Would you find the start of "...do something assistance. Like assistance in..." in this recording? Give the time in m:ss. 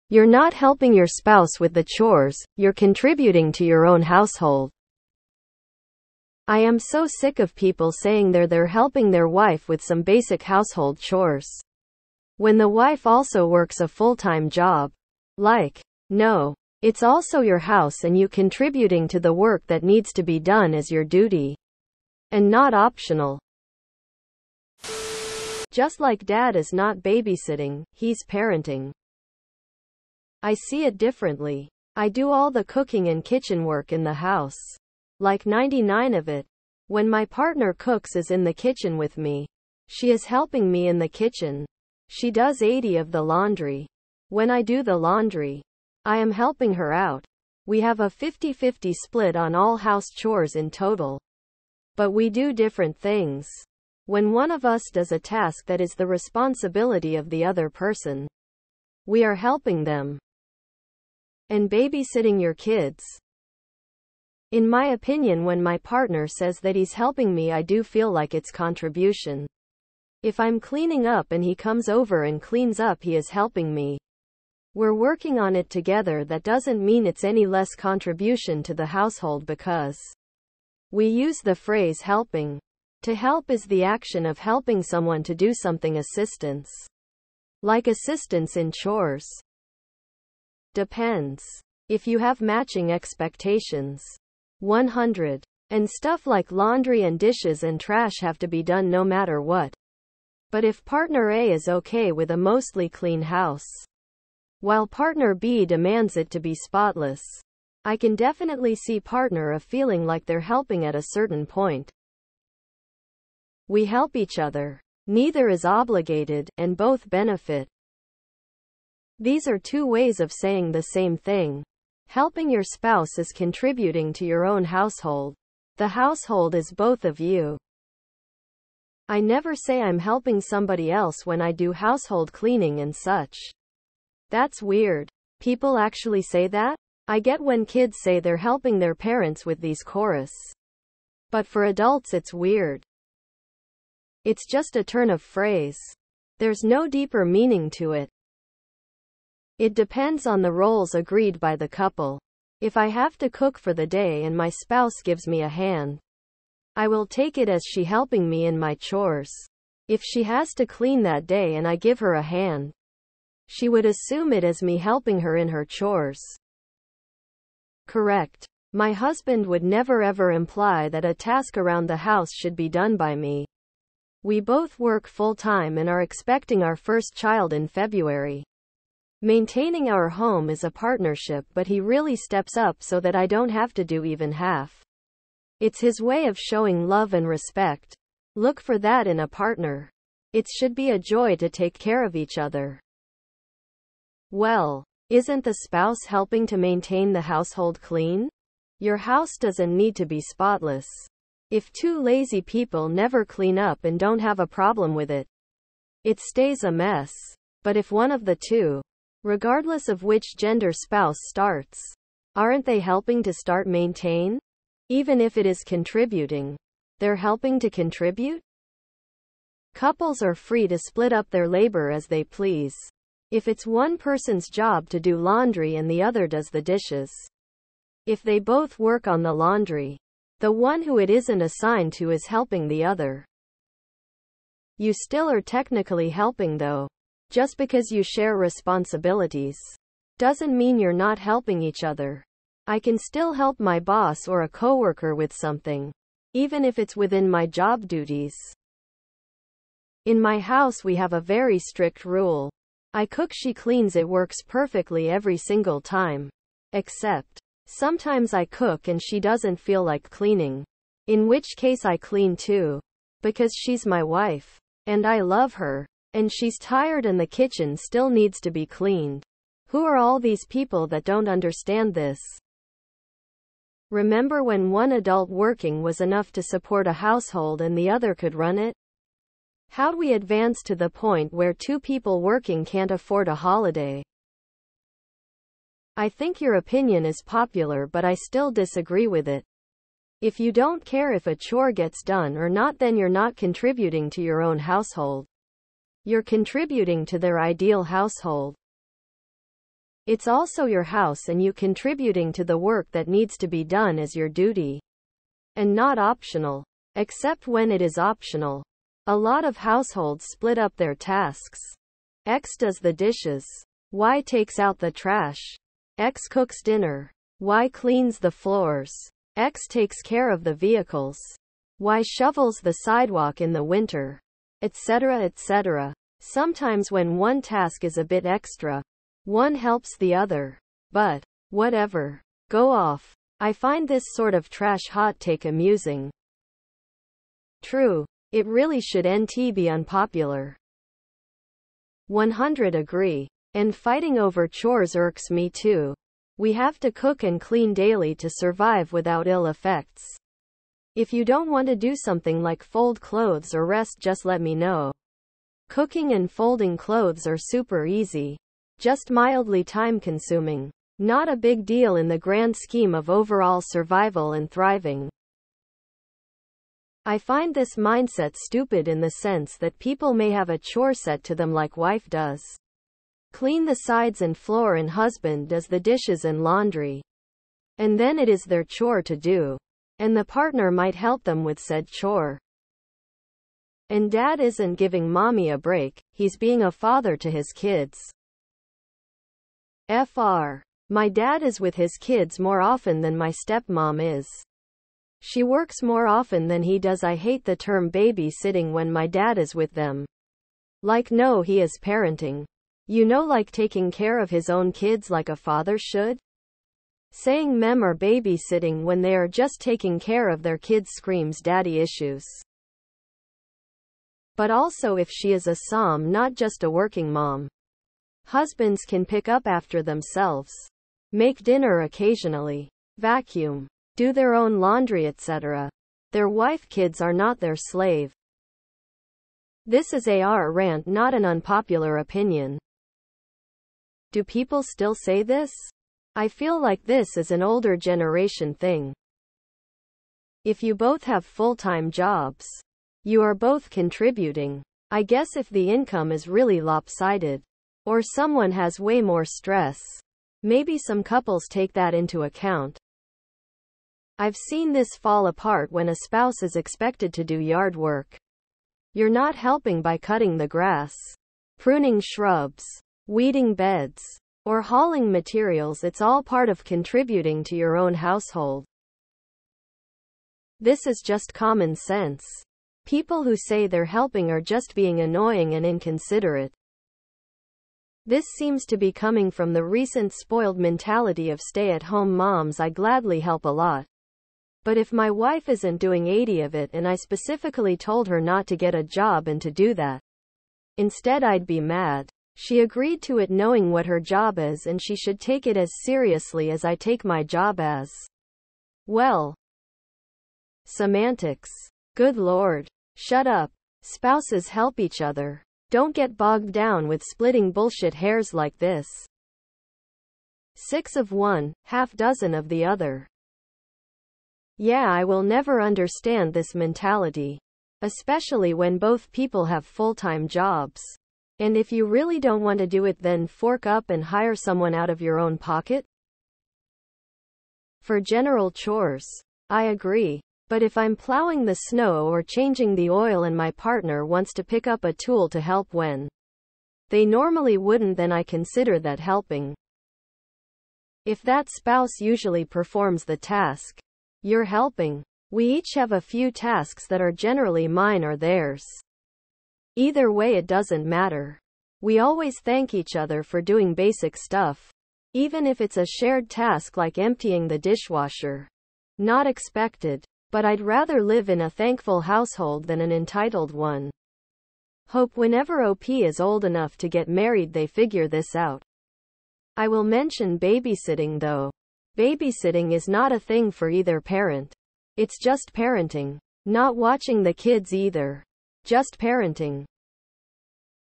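1:25.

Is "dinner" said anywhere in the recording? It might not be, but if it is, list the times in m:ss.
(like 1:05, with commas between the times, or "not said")
5:16, 7:01.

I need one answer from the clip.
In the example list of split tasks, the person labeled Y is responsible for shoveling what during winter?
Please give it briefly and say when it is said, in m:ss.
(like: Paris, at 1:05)
the sidewalk, at 5:22.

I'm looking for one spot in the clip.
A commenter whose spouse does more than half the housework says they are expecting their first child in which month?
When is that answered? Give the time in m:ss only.
2:57.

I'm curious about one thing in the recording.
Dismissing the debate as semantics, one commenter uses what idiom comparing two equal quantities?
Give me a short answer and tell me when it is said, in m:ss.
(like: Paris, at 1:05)
Six of one, half dozen of the other, at 8:30.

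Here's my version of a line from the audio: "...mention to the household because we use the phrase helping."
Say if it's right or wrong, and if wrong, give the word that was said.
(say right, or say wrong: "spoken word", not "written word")
wrong: "contribution", not "mention".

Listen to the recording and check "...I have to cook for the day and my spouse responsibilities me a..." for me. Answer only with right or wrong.
wrong.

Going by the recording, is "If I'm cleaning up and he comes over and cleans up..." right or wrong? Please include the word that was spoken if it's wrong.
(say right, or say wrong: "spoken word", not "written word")
right.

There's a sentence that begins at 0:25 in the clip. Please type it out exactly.
Just like dad is not babysitting, he's parenting.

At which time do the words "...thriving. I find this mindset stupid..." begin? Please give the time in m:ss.
6:04.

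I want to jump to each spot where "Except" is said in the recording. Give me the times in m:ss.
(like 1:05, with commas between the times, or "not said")
4:16, 5:06.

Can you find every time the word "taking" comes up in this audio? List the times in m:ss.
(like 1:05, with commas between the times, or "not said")
6:43, 6:49.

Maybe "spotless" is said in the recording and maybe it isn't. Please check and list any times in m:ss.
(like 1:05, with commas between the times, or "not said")
1:46, 3:20.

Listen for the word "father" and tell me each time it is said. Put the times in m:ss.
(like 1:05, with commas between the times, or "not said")
6:26, 6:45.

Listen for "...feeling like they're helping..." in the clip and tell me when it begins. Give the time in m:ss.
1:49.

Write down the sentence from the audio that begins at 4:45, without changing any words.
I think your opinion is popular but I still disagree with it.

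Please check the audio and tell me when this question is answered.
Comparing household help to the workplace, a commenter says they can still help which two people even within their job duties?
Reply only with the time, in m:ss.
4:03.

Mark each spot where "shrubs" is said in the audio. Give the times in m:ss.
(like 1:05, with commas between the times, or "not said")
7:42.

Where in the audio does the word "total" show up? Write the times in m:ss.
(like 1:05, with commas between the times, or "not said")
0:50.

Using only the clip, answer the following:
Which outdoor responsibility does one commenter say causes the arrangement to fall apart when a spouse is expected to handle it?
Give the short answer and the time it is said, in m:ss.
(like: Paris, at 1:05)
yard work, at 7:37.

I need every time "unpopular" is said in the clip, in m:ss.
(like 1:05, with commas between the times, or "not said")
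5:39, 7:11.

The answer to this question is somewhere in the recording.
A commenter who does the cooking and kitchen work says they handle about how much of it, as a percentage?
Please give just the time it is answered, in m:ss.
0:35.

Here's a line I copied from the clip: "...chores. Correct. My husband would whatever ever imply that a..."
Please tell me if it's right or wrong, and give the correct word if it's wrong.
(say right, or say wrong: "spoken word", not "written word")
wrong: "never", not "whatever".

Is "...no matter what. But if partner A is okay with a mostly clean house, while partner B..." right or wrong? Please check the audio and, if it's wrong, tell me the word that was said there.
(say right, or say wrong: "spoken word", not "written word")
right.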